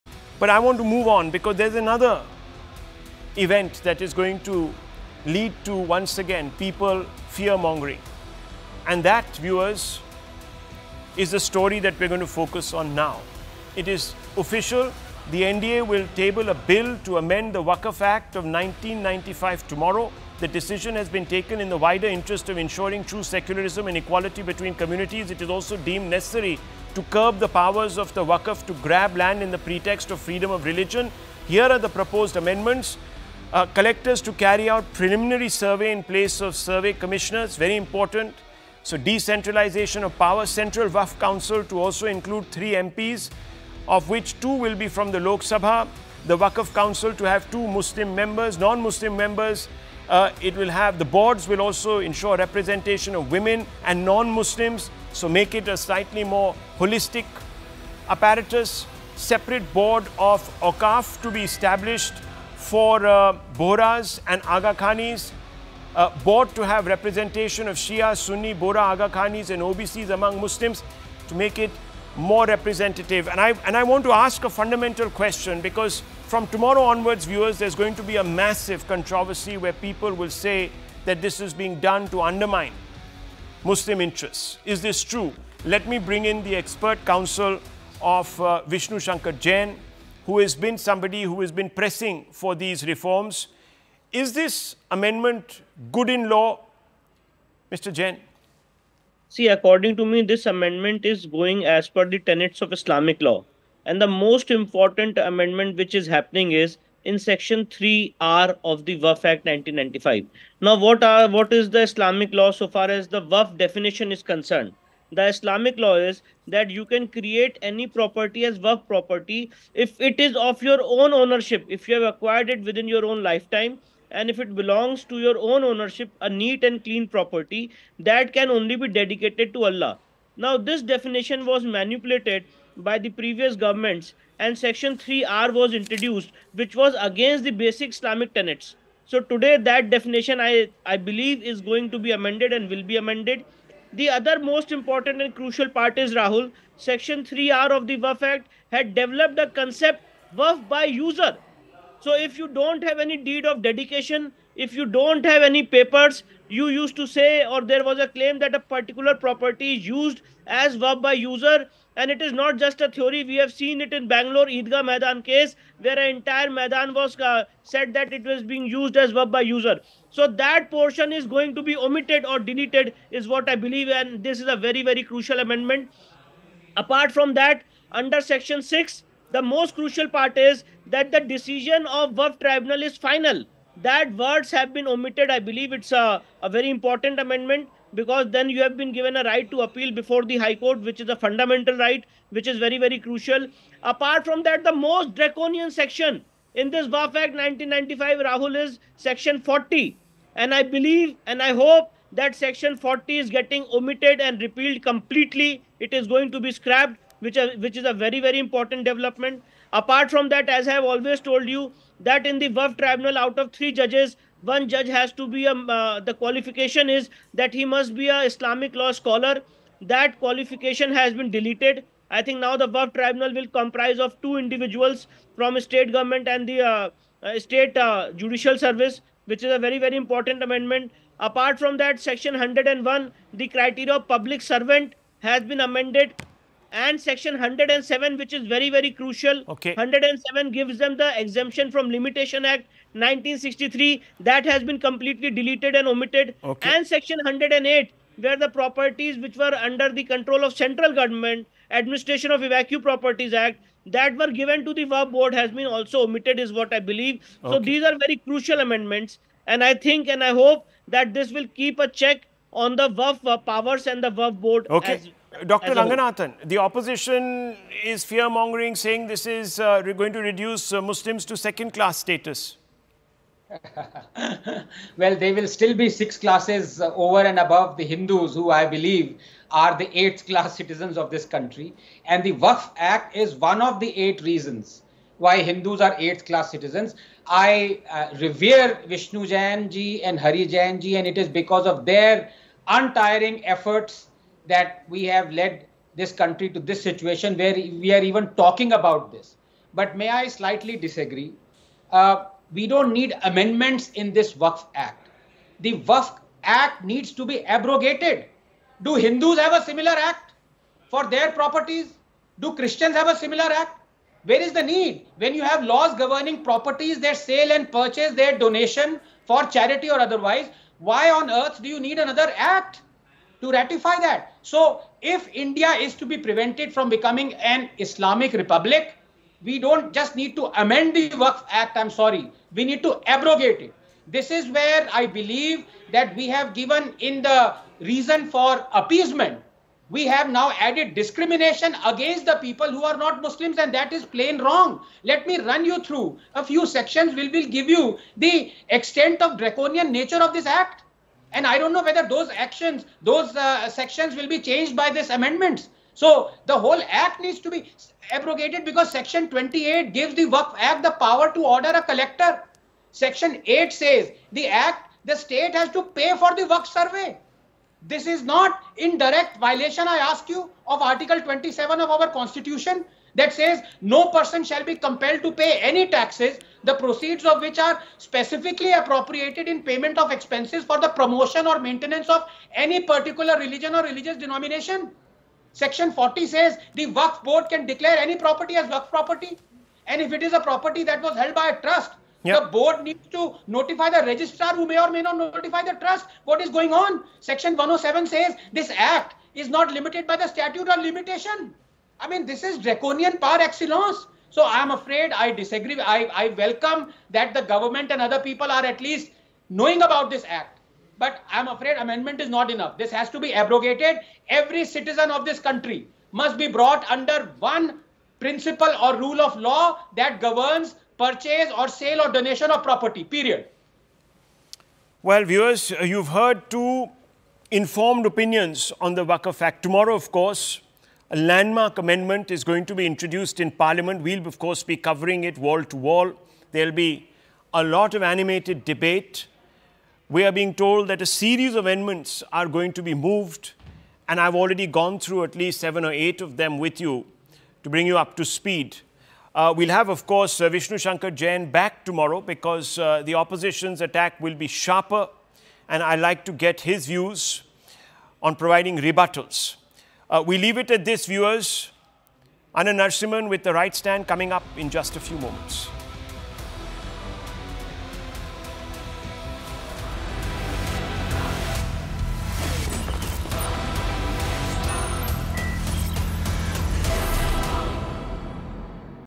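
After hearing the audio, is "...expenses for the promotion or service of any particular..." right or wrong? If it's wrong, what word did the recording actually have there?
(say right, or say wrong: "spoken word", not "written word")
wrong: "maintenance", not "service".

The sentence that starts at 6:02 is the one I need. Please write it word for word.
Section 8 says the act, the state has to pay for the Waqf survey.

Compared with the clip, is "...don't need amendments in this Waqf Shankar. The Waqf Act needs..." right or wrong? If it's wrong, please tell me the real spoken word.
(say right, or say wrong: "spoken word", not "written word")
wrong: "Act", not "Shankar".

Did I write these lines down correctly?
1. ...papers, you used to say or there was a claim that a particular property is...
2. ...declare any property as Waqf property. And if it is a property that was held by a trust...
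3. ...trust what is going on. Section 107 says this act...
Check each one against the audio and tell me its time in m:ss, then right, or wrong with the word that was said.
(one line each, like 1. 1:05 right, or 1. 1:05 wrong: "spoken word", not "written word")
1. 2:35 right
2. 6:27 right
3. 6:35 right.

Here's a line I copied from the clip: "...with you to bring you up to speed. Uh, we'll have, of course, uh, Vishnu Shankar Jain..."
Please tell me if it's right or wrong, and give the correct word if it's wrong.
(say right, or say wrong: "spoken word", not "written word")
right.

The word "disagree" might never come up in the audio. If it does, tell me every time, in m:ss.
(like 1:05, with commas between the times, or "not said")
5:00, 6:45.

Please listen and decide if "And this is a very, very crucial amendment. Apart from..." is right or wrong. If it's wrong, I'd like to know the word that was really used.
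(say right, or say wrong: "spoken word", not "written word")
right.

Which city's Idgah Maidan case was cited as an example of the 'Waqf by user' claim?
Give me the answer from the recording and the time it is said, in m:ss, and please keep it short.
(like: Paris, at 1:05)
Bangalore, at 2:44.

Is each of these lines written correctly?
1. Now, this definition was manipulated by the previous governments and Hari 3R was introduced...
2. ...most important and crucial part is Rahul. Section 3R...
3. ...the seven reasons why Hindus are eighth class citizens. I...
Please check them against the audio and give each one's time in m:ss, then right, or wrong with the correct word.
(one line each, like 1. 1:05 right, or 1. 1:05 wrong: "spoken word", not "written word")
1. 2:10 wrong: "Section", not "Hari"
2. 2:24 right
3. 4:43 wrong: "eight", not "seven".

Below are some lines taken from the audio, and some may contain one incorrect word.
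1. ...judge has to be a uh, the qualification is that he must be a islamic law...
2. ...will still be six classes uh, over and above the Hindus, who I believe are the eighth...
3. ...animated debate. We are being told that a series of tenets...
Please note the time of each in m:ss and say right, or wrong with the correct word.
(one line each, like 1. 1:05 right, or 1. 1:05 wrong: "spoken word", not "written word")
1. 3:34 right
2. 4:35 right
3. 7:18 wrong: "amendments", not "tenets".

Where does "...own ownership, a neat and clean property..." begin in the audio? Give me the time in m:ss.
2:05.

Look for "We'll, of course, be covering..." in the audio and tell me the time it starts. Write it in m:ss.
7:14.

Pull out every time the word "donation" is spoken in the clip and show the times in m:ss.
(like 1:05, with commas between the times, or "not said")
5:18, 7:02.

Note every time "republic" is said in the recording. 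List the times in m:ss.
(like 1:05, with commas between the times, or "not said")
5:28.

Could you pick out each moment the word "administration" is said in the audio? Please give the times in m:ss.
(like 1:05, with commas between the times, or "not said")
4:11.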